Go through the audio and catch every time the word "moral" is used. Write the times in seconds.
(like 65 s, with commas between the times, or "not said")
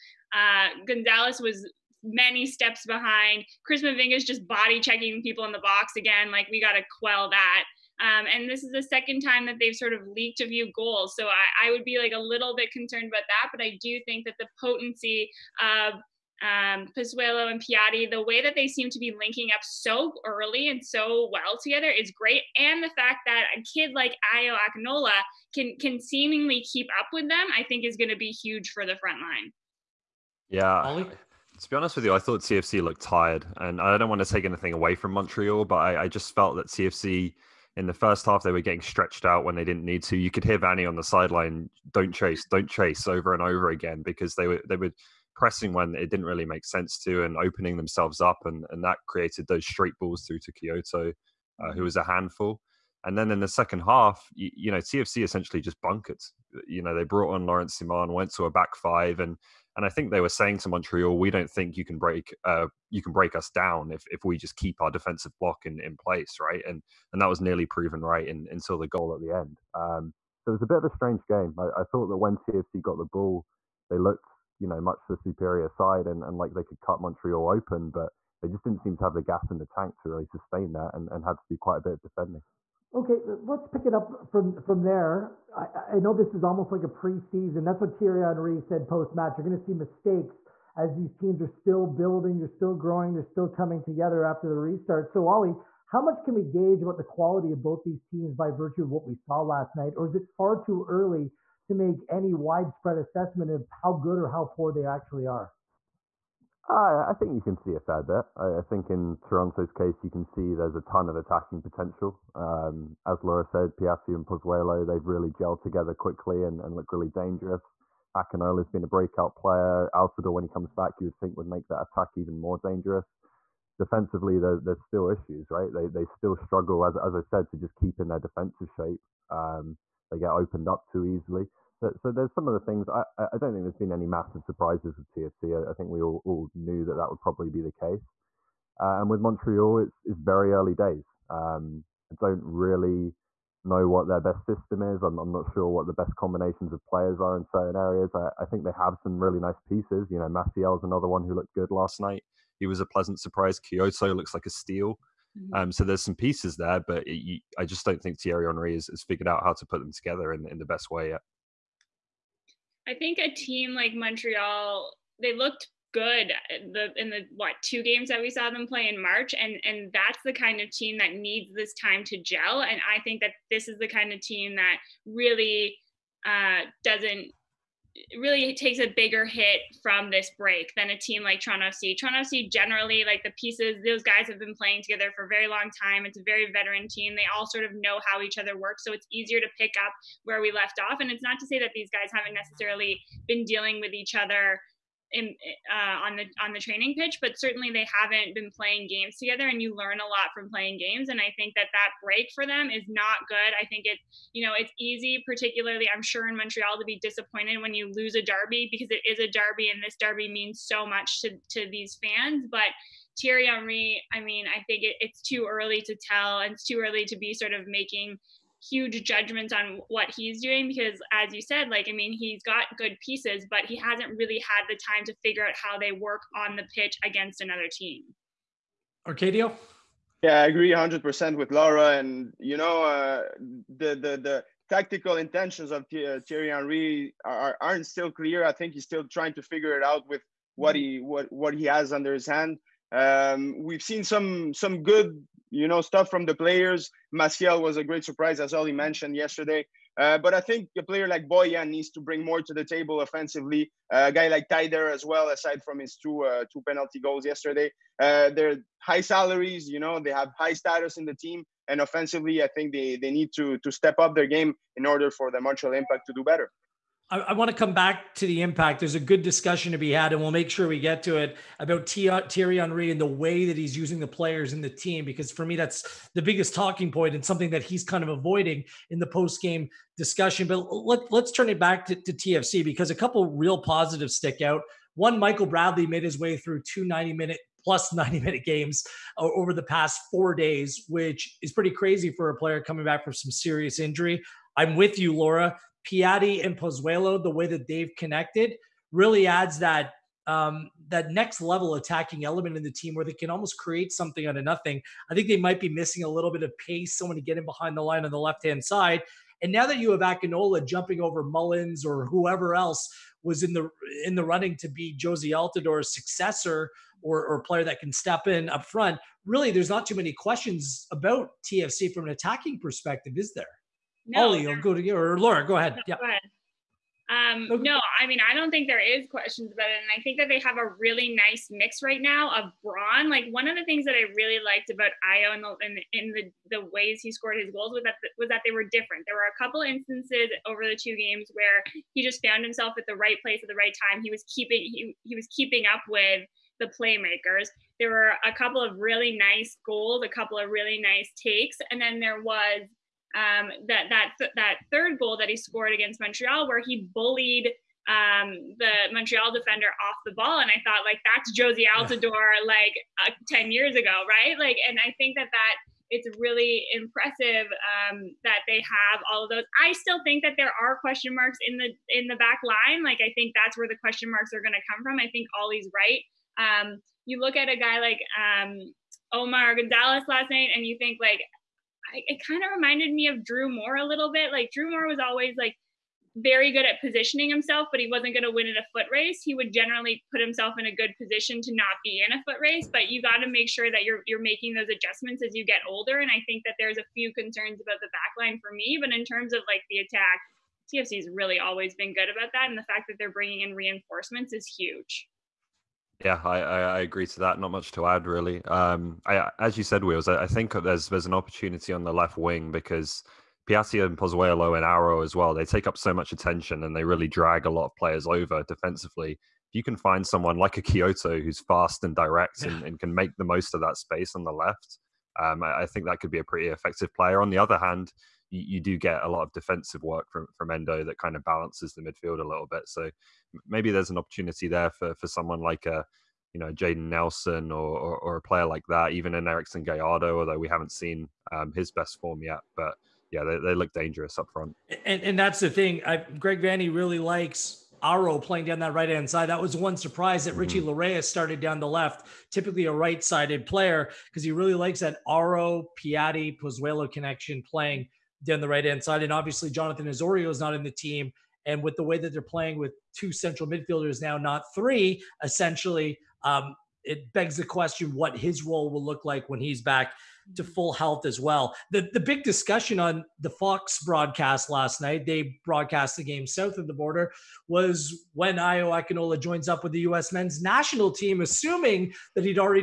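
not said.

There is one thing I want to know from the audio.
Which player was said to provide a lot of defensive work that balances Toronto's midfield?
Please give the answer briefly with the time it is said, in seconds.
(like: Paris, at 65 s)
Endo, at 430 s.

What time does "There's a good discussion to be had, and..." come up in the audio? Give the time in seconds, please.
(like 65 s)
268 s.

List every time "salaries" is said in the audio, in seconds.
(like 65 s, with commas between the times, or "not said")
259 s.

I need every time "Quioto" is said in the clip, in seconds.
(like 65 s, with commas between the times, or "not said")
50 s, 153 s, 420 s.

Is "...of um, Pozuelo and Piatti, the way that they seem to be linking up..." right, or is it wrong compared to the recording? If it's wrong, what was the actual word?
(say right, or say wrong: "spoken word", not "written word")
right.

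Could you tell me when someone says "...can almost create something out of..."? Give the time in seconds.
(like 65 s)
303 s.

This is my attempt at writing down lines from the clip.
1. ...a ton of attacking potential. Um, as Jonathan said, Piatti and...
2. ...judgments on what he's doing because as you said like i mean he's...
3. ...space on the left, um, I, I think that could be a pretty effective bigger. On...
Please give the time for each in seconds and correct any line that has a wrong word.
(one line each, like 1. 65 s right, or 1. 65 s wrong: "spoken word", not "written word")
1. 110 s wrong: "Laura", not "Jonathan"
2. 219 s right
3. 423 s wrong: "player", not "bigger".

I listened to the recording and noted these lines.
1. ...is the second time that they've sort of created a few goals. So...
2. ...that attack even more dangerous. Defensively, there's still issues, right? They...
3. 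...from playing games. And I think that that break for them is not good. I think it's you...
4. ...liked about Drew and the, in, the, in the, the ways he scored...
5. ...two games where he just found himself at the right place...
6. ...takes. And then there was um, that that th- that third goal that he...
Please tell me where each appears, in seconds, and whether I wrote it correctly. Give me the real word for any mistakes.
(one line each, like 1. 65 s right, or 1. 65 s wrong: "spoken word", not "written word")
1. 8 s wrong: "leaked", not "created"
2. 121 s right
3. 200 s right
4. 334 s wrong: "Ayo", not "Drew"
5. 340 s right
6. 351 s right.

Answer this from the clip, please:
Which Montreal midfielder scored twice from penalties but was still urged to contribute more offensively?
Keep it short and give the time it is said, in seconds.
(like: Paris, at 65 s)
Taider, at 254 s.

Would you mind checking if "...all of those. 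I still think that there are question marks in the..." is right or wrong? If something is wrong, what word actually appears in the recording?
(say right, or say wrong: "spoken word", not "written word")
right.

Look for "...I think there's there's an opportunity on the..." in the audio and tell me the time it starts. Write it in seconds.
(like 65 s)
410 s.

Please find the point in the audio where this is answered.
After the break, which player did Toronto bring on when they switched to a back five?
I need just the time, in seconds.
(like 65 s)
57 s.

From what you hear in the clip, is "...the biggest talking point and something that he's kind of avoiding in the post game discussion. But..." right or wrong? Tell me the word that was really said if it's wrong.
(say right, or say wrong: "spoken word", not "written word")
right.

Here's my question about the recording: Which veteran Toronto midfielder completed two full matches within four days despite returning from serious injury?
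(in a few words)
Michael Bradley.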